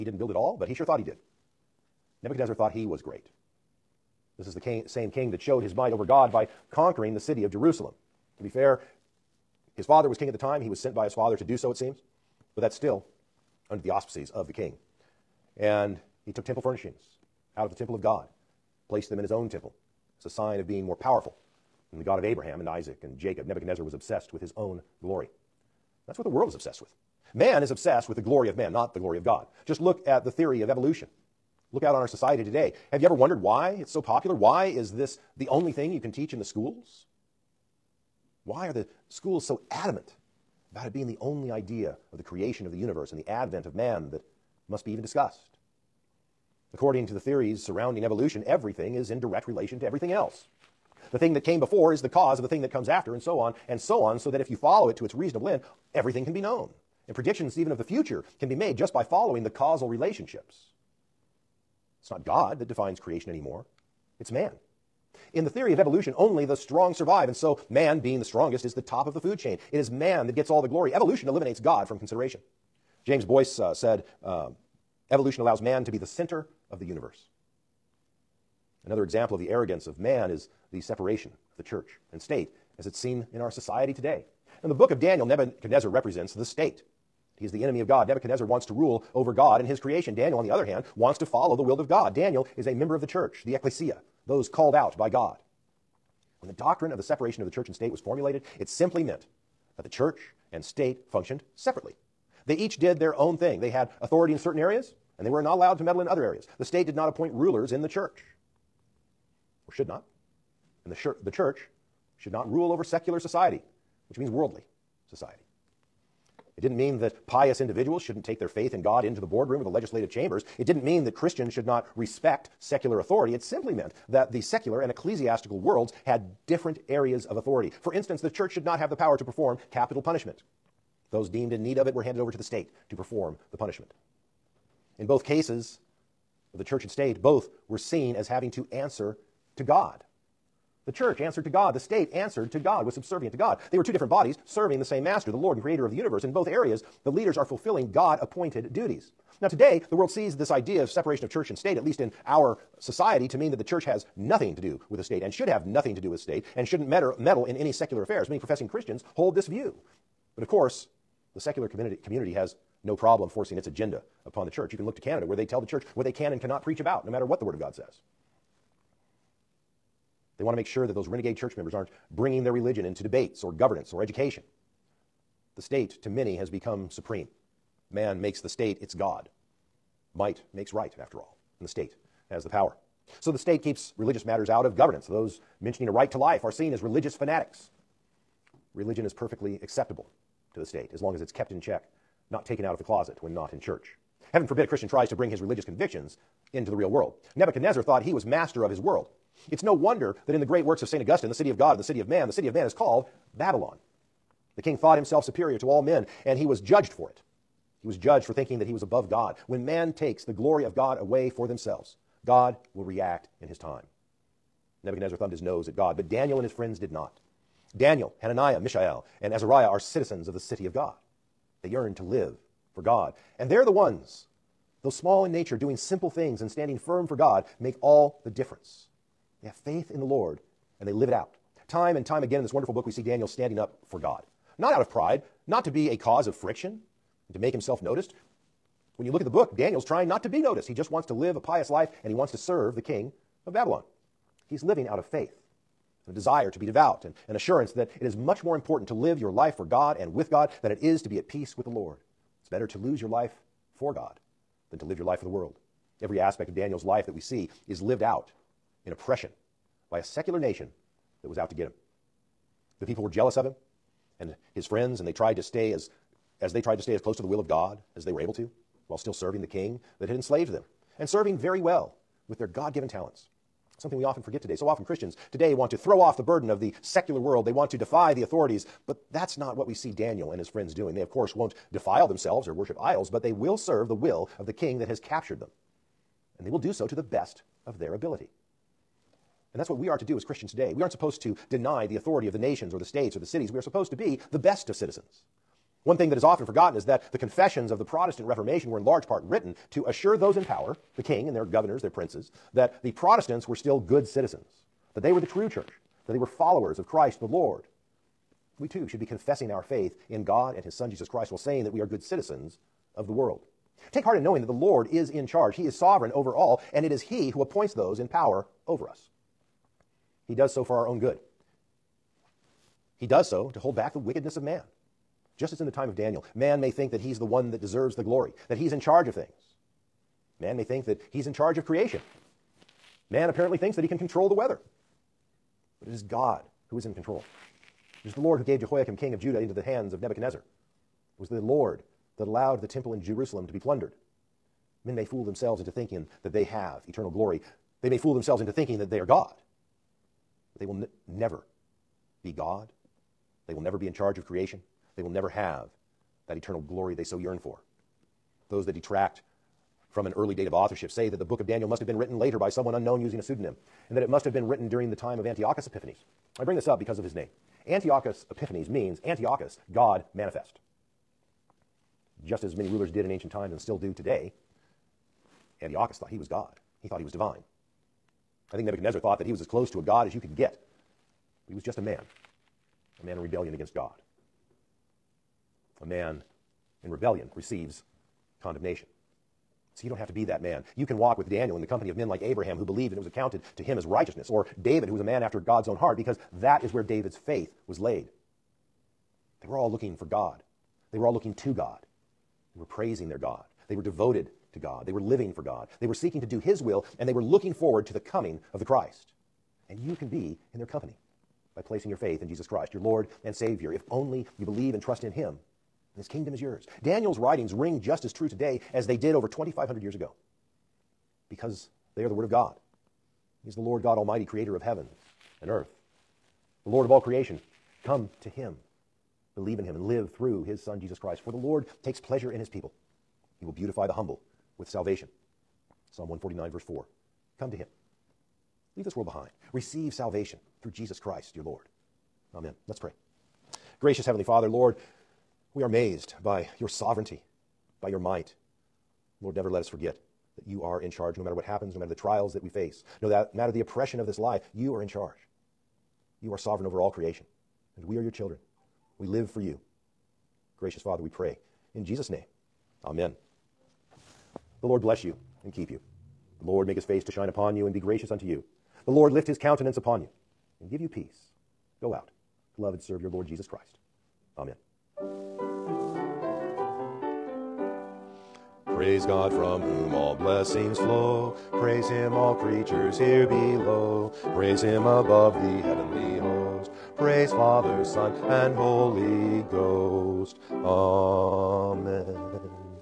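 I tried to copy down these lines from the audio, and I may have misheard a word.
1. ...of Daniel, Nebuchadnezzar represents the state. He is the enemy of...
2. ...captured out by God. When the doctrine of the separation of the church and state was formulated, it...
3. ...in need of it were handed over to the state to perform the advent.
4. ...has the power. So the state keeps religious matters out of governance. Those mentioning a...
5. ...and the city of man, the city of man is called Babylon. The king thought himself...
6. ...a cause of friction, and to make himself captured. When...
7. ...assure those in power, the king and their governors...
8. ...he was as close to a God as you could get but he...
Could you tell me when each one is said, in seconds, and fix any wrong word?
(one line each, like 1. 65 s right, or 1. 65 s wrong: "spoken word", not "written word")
1. 84 s right
2. 94 s wrong: "called", not "captured"
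3. 131 s wrong: "punishment", not "advent"
4. 182 s right
5. 201 s right
6. 235 s wrong: "noticed", not "captured"
7. 299 s right
8. 379 s right.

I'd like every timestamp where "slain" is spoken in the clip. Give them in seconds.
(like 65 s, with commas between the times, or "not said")
not said.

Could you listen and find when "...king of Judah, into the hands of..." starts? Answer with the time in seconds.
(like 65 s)
338 s.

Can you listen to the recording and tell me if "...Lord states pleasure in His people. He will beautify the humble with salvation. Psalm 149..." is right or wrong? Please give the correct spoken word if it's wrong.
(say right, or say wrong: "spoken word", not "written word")
wrong: "takes", not "states".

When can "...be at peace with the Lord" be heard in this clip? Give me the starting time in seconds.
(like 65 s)
251 s.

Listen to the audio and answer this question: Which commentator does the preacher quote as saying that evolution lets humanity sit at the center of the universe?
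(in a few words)
James Boice.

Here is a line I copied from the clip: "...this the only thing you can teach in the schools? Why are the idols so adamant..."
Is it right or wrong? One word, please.
wrong.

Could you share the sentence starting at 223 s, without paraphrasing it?
And they're the ones, though small in nature, doing simple things and standing firm for God, make all the difference.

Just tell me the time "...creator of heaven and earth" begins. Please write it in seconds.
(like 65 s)
424 s.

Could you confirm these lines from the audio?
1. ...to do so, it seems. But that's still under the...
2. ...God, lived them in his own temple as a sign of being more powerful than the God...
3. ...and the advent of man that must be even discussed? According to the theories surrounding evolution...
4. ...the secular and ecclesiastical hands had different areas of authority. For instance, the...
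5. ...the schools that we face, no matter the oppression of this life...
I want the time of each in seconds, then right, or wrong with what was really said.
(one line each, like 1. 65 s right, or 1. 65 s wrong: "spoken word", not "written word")
1. 11 s right
2. 18 s wrong: "placed", not "lived"
3. 43 s right
4. 124 s wrong: "worlds", not "hands"
5. 451 s wrong: "trials", not "schools".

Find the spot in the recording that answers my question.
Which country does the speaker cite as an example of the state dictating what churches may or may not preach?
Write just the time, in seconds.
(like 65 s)
164 s.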